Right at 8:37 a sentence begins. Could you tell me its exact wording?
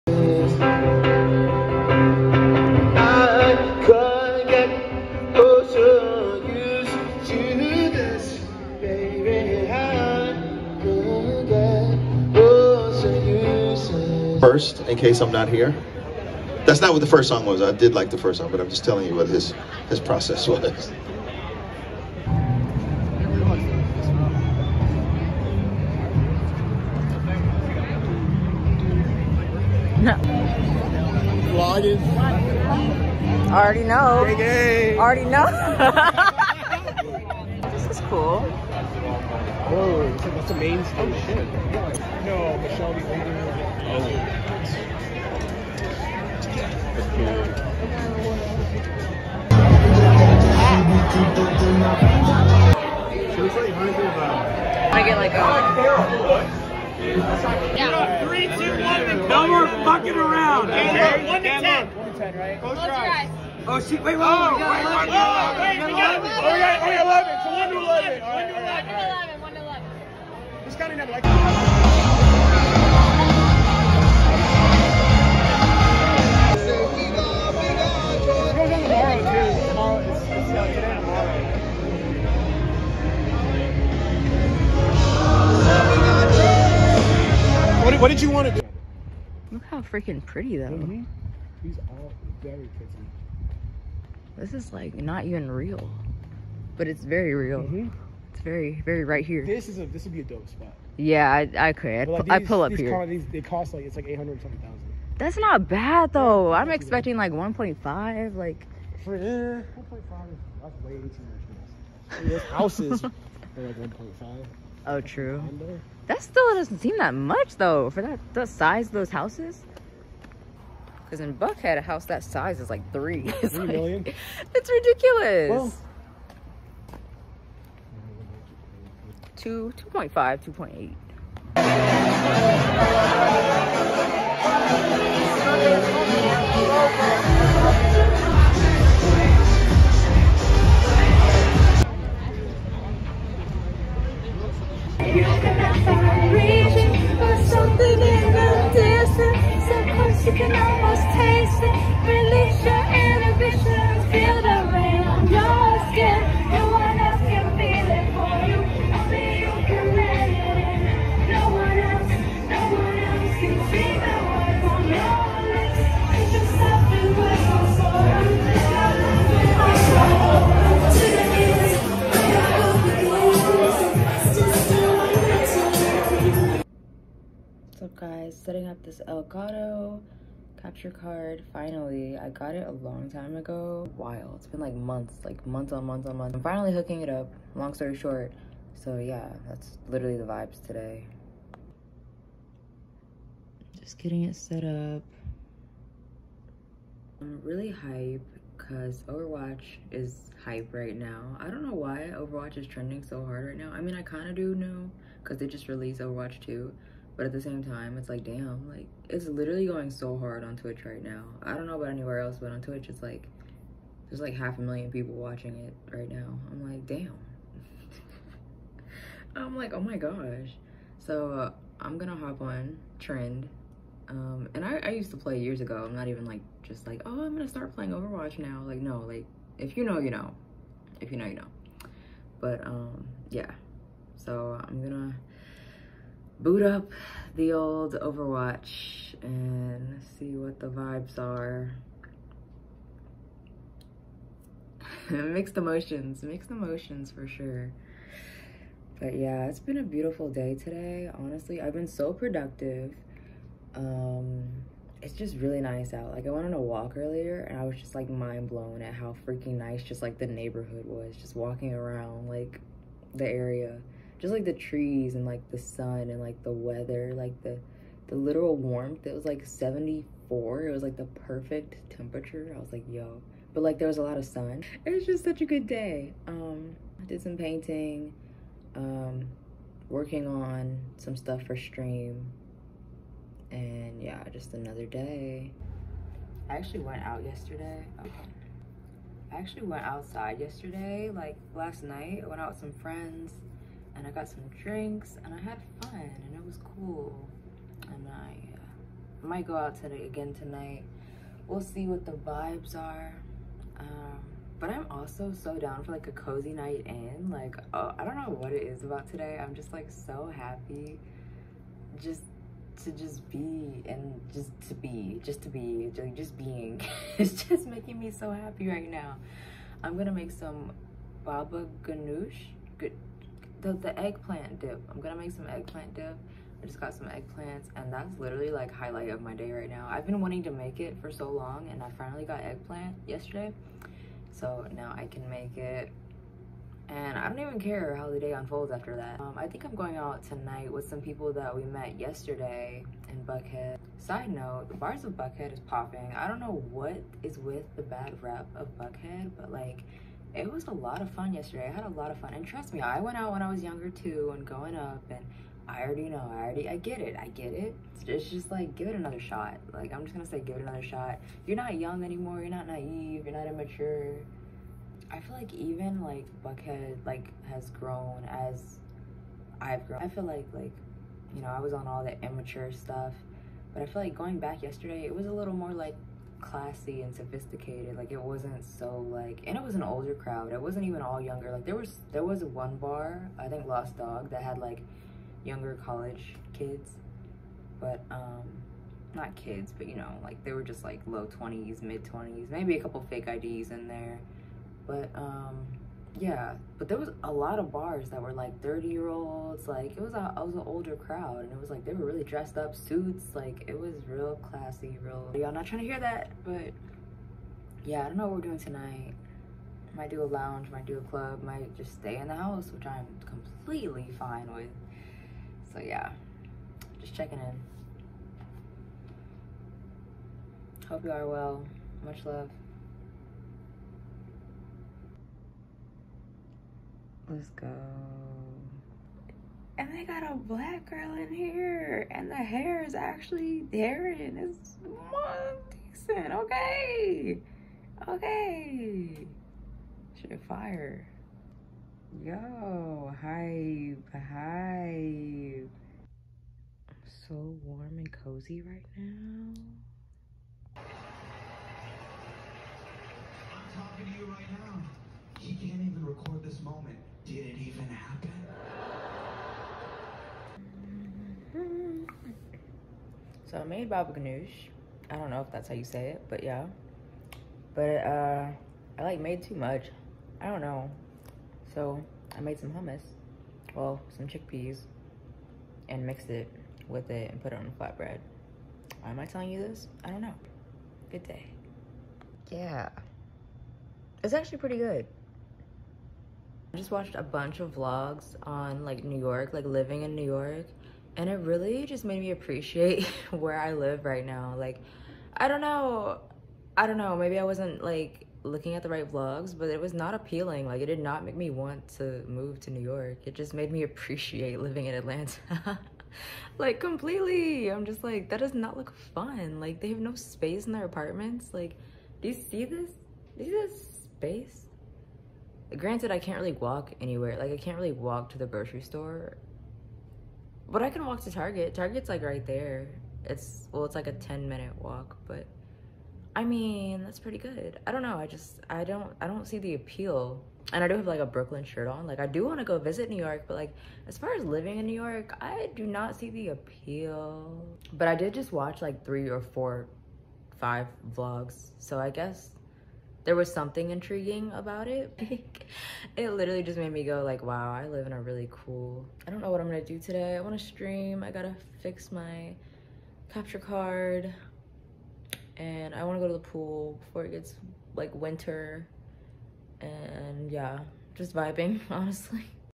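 Like, I can't really walk to the grocery store.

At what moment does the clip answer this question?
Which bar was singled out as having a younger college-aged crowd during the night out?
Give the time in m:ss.
6:23.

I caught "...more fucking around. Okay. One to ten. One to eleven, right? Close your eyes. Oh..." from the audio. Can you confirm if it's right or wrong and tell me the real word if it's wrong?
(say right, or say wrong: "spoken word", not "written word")
wrong: "ten", not "eleven".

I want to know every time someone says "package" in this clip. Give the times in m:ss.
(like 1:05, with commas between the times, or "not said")
not said.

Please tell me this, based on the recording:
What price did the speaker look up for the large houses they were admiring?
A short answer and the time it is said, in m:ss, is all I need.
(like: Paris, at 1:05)
Eight hundred something thousand, at 1:44.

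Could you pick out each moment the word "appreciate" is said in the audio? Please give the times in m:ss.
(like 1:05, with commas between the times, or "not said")
8:12, 8:23.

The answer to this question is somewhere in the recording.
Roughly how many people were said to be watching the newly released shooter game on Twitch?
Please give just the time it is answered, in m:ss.
3:34.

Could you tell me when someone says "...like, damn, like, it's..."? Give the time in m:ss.
3:28.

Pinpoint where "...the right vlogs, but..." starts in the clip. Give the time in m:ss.
8:18.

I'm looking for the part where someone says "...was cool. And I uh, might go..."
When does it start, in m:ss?
4:56.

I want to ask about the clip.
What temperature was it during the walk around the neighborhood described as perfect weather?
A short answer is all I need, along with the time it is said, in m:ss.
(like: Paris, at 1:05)
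74, at 4:29.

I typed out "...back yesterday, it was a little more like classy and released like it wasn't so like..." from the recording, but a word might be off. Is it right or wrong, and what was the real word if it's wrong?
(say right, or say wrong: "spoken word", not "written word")
wrong: "sophisticated", not "released".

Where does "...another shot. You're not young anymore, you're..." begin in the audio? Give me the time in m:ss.
6:00.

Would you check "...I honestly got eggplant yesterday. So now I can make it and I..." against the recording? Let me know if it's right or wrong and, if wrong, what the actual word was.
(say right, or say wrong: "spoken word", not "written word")
wrong: "finally", not "honestly".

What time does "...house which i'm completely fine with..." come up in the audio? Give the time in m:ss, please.
6:52.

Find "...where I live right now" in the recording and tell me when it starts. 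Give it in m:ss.
8:13.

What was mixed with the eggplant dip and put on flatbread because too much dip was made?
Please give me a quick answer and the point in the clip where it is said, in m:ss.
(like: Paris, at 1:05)
Chickpeas, at 7:54.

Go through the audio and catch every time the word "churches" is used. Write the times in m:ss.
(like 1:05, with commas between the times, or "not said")
not said.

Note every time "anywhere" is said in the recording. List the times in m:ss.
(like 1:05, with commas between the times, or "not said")
3:31, 8:36.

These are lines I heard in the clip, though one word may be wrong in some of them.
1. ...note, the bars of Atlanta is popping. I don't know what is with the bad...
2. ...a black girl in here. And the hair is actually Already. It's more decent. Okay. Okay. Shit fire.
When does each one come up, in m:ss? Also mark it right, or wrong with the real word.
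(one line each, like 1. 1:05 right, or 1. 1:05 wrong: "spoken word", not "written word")
1. 5:44 wrong: "Buckhead", not "Atlanta"
2. 7:10 wrong: "Darren", not "Already".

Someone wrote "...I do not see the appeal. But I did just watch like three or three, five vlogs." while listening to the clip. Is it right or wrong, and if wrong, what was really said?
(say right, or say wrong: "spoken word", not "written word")
wrong: "four", not "three".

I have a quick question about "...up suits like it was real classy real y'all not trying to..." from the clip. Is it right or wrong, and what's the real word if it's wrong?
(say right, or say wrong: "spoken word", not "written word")
right.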